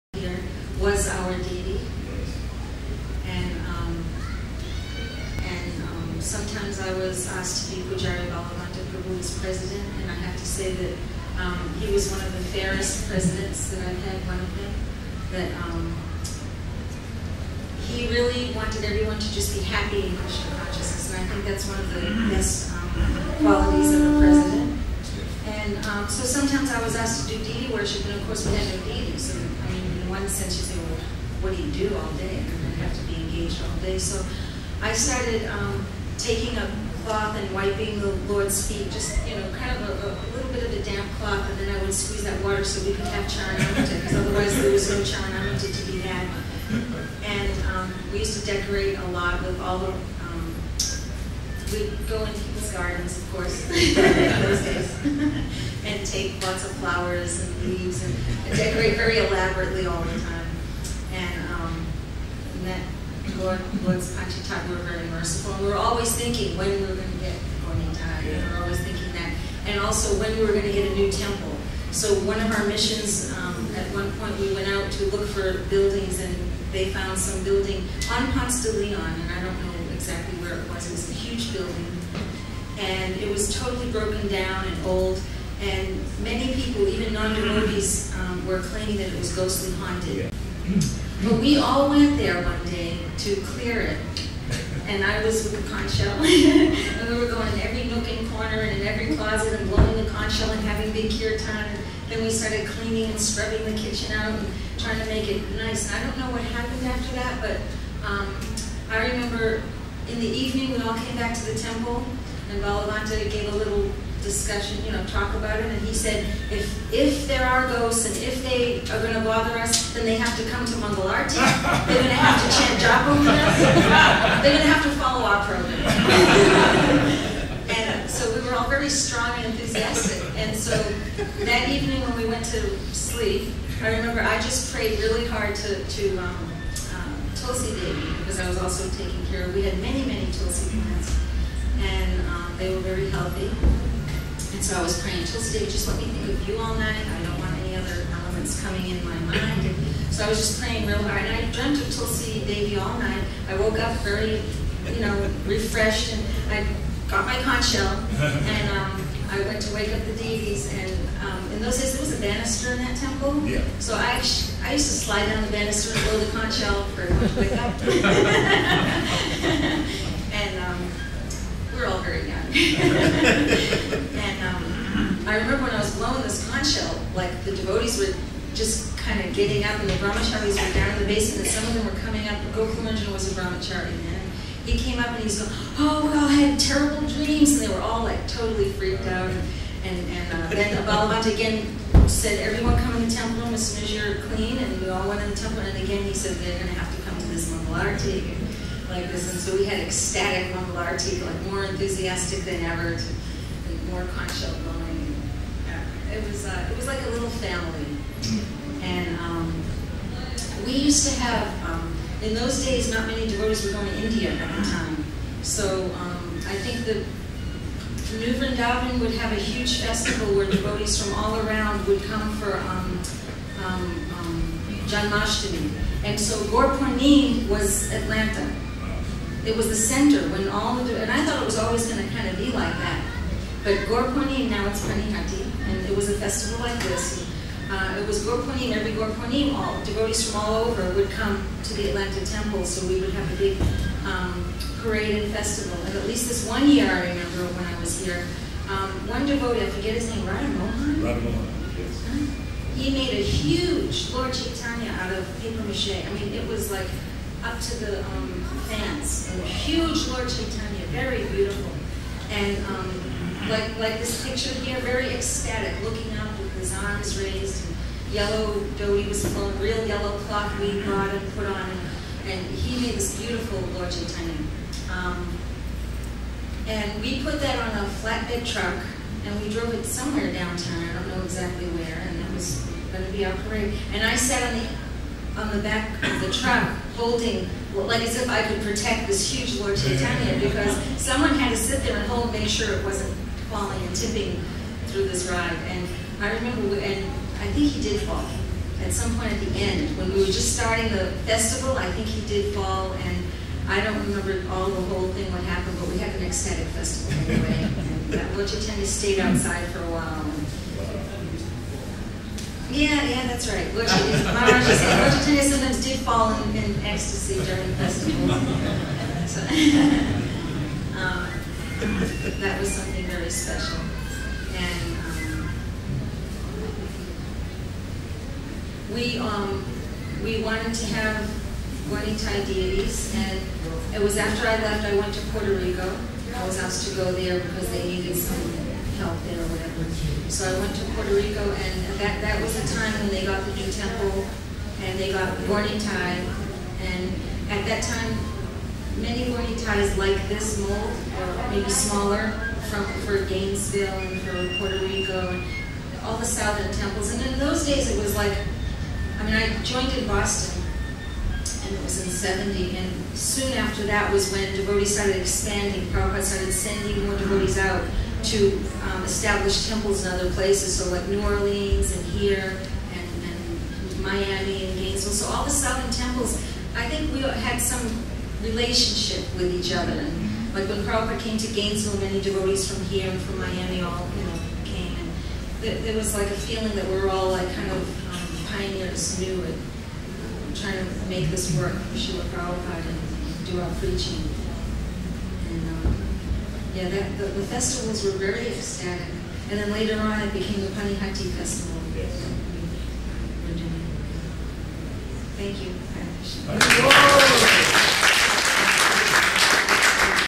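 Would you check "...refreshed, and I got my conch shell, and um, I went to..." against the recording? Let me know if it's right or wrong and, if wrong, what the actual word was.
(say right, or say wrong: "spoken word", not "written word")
right.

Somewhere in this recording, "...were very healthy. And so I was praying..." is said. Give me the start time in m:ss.
2:22.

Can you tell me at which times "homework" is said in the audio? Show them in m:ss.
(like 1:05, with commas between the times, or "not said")
not said.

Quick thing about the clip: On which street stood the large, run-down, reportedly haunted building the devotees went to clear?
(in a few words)
Ponce de Leon.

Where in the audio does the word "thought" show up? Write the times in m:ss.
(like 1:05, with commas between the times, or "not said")
3:51.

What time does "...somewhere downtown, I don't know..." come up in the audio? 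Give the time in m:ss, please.
4:39.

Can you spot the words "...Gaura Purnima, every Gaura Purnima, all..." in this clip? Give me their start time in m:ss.
3:58.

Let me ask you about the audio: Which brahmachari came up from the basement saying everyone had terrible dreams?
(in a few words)
Gokulanjan.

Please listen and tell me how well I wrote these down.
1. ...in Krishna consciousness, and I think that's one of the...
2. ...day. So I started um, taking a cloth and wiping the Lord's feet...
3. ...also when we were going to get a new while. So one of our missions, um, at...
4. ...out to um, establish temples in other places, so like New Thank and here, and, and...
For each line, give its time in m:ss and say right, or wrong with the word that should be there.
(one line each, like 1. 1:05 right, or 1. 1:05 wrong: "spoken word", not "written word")
1. 0:20 right
2. 0:33 right
3. 1:09 wrong: "temple", not "while"
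4. 6:07 wrong: "Orleans", not "Thank".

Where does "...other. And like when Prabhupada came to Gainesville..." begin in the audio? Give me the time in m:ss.
6:19.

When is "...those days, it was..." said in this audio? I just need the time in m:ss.
5:57.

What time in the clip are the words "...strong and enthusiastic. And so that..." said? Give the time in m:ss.
2:08.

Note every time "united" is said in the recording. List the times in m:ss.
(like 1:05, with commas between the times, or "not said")
not said.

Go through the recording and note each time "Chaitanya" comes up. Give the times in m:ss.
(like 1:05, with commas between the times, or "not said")
4:14, 4:20, 4:33, 4:49, 5:08.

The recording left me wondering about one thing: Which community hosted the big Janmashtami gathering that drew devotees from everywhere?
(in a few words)
New Vrindavan.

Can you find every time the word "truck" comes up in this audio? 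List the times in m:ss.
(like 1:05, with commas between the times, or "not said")
4:38, 4:46.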